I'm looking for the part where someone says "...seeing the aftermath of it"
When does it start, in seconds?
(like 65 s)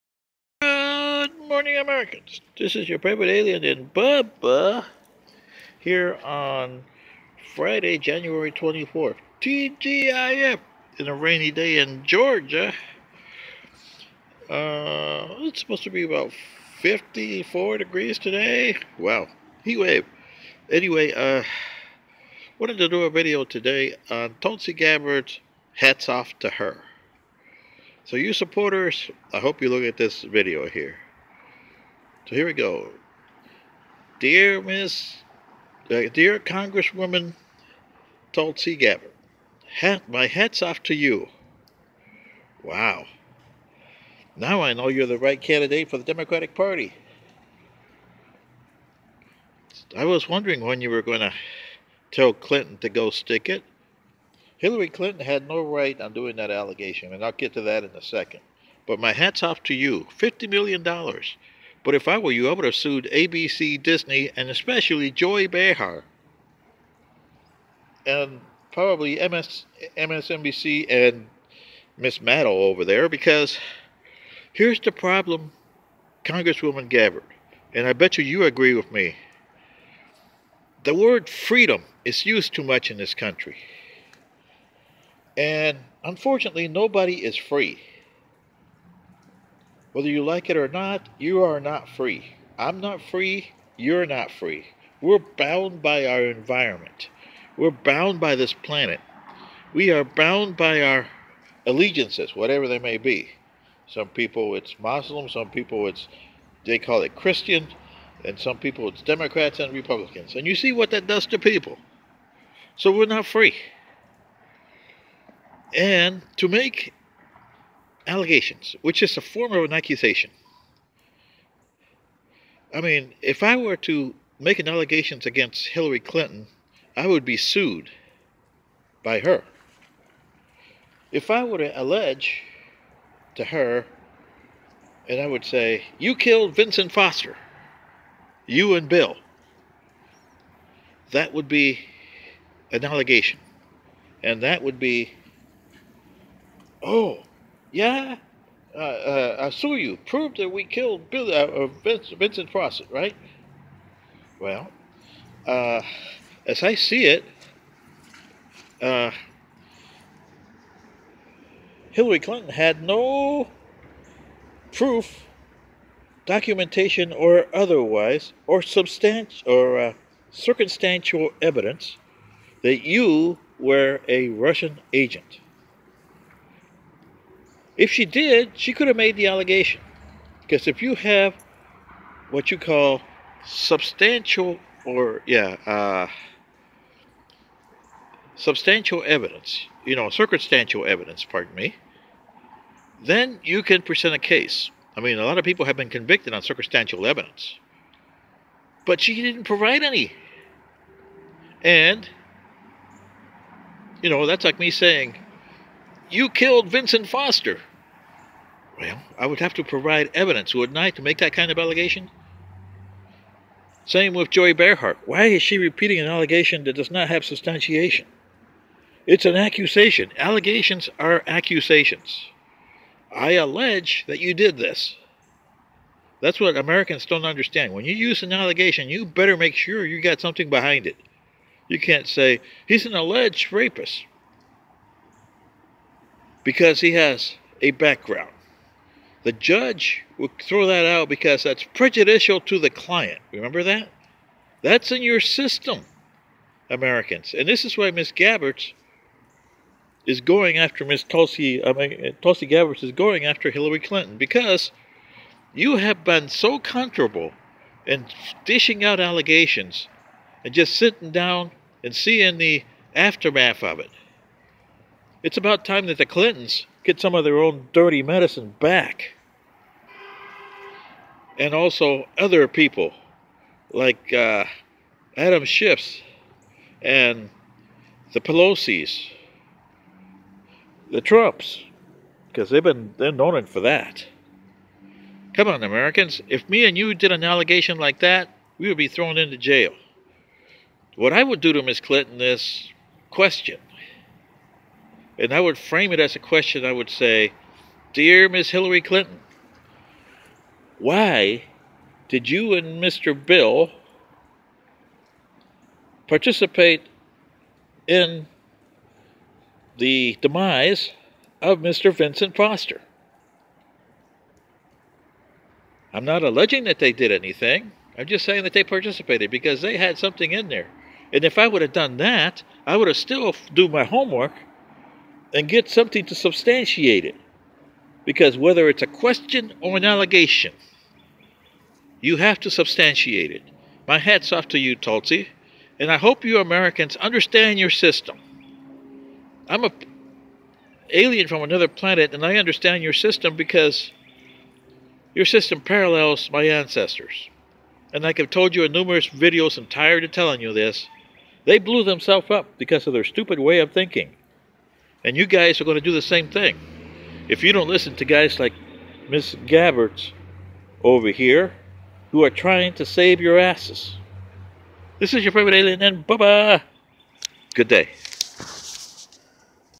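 261 s.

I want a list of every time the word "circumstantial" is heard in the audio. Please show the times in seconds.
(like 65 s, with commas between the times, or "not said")
170 s, 190 s, 196 s.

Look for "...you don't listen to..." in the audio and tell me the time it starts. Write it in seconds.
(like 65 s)
357 s.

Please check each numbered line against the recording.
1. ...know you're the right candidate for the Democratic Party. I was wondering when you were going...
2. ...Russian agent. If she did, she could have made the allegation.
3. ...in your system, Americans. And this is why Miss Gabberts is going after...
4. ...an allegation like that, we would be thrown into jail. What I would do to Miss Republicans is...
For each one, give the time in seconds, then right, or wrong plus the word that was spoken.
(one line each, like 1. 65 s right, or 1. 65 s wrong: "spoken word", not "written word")
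1. 44 s right
2. 174 s right
3. 244 s right
4. 287 s wrong: "Clinton", not "Republicans".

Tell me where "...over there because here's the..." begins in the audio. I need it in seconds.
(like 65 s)
72 s.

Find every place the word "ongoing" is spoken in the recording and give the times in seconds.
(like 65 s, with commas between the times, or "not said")
not said.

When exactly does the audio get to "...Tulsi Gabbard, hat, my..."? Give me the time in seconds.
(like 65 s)
38 s.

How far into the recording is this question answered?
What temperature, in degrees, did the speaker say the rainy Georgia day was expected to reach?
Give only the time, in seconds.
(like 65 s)
16 s.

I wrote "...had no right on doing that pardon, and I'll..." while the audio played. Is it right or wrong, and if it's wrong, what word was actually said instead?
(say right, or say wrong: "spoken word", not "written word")
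wrong: "allegation", not "pardon".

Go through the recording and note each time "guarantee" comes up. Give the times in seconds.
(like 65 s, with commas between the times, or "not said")
not said.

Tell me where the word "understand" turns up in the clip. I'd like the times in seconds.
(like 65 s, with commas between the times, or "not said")
227 s, 336 s, 342 s.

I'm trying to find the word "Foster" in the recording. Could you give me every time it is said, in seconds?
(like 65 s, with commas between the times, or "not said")
136 s, 207 s, 312 s.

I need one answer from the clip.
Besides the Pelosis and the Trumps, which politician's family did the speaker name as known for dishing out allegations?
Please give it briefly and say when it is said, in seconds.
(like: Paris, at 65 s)
Adam Schiff, at 275 s.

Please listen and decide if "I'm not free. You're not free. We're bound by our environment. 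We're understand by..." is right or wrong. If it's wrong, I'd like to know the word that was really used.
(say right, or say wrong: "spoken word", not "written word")
wrong: "bound", not "understand".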